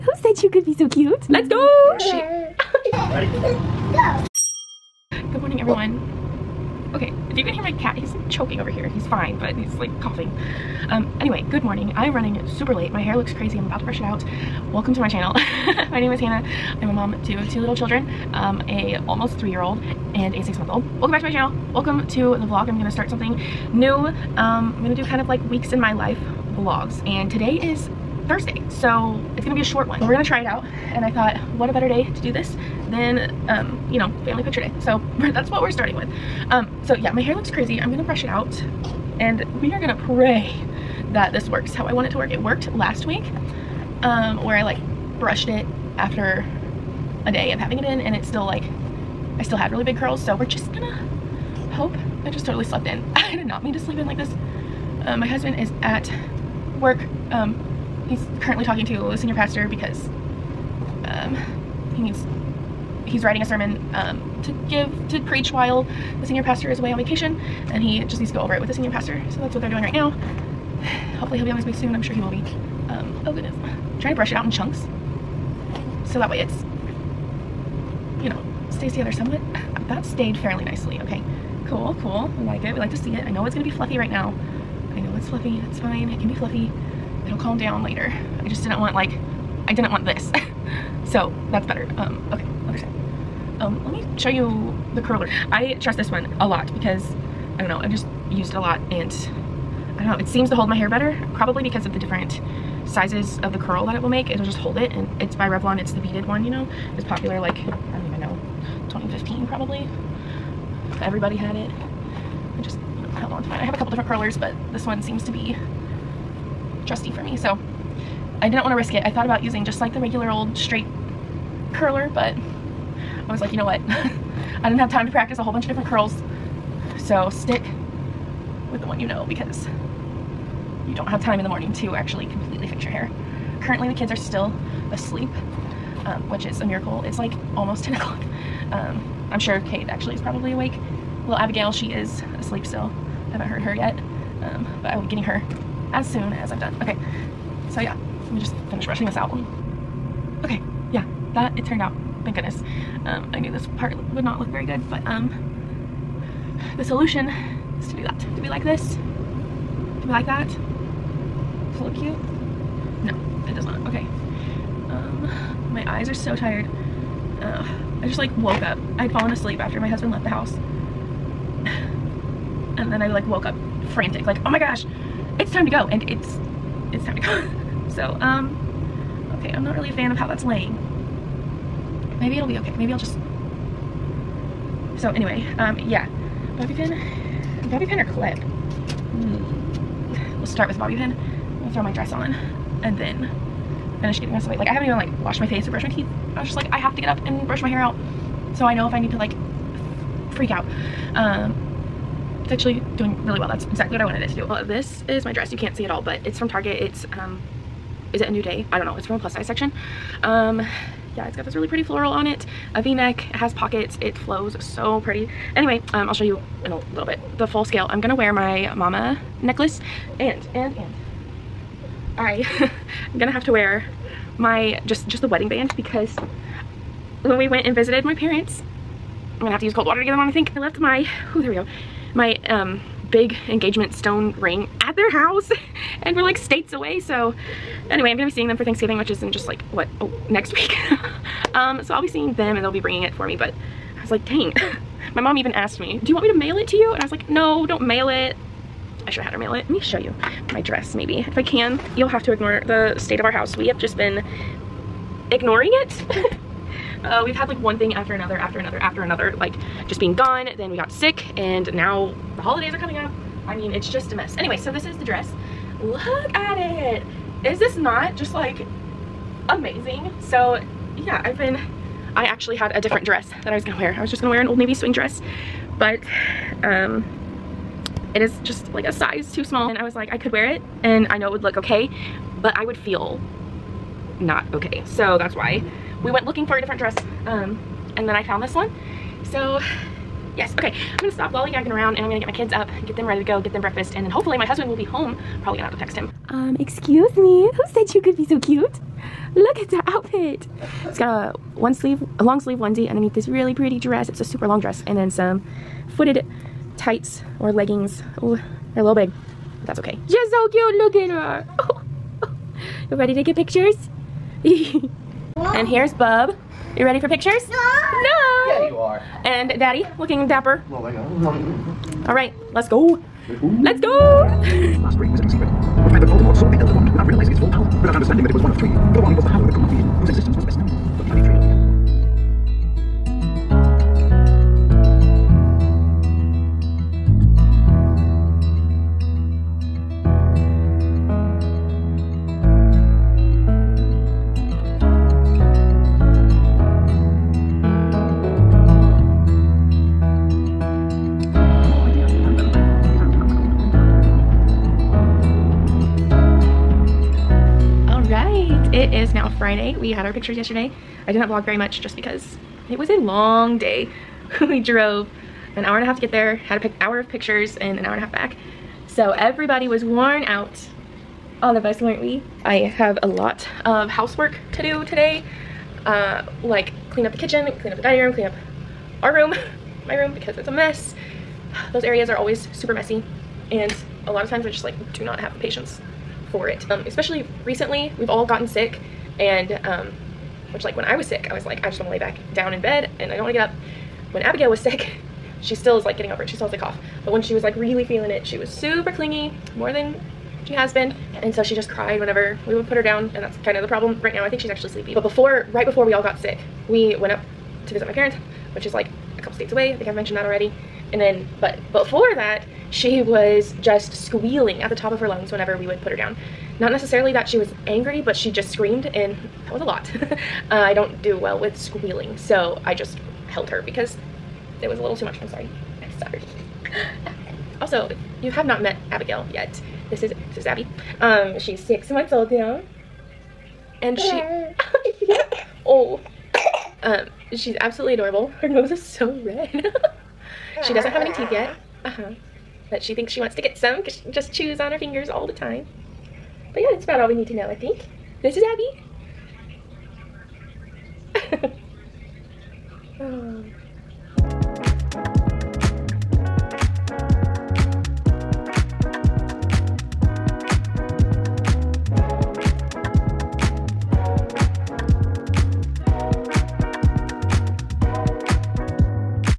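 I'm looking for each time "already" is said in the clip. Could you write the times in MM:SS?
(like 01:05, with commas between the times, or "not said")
06:50.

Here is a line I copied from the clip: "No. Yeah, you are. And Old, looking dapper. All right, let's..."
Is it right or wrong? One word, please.
wrong.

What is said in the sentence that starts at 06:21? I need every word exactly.
Those areas are always super messy and a lot of times I just like do not have the patience for it.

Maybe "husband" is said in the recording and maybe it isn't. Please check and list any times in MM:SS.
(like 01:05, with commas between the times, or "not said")
00:55, 02:49, 04:54.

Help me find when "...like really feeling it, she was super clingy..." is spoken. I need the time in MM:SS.
06:37.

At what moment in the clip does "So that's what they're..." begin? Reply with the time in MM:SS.
01:09.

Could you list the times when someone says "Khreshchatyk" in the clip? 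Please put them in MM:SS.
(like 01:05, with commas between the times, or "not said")
not said.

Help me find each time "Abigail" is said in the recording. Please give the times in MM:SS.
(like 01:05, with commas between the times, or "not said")
02:21, 06:34, 07:08.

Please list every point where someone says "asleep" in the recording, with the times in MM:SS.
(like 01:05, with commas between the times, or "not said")
02:14, 02:22, 02:49.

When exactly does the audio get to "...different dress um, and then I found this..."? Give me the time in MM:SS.
04:46.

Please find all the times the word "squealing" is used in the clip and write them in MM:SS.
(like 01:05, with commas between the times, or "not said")
06:53, 07:01.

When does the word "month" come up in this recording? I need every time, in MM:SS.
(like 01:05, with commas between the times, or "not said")
00:20, 07:11.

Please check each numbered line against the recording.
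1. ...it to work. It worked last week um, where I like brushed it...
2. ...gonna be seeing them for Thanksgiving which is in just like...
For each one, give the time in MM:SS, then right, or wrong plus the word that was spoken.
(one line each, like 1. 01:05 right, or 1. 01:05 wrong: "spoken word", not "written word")
1. 00:42 right
2. 03:58 right.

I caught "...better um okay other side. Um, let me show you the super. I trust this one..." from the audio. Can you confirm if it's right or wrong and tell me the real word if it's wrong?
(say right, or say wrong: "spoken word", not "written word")
wrong: "curler", not "super".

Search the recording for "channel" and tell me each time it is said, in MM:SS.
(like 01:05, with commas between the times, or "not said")
00:15, 00:21.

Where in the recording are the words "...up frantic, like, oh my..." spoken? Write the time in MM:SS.
02:53.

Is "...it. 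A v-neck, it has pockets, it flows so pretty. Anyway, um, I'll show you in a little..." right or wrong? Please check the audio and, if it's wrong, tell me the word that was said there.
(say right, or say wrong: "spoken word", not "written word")
right.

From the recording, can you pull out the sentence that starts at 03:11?
I'll throw my dress on and then finish getting my away.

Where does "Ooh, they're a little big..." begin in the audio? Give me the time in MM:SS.
05:08.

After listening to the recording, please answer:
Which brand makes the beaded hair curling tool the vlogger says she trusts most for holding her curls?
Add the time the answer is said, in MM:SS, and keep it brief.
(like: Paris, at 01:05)
Revlon, at 01:45.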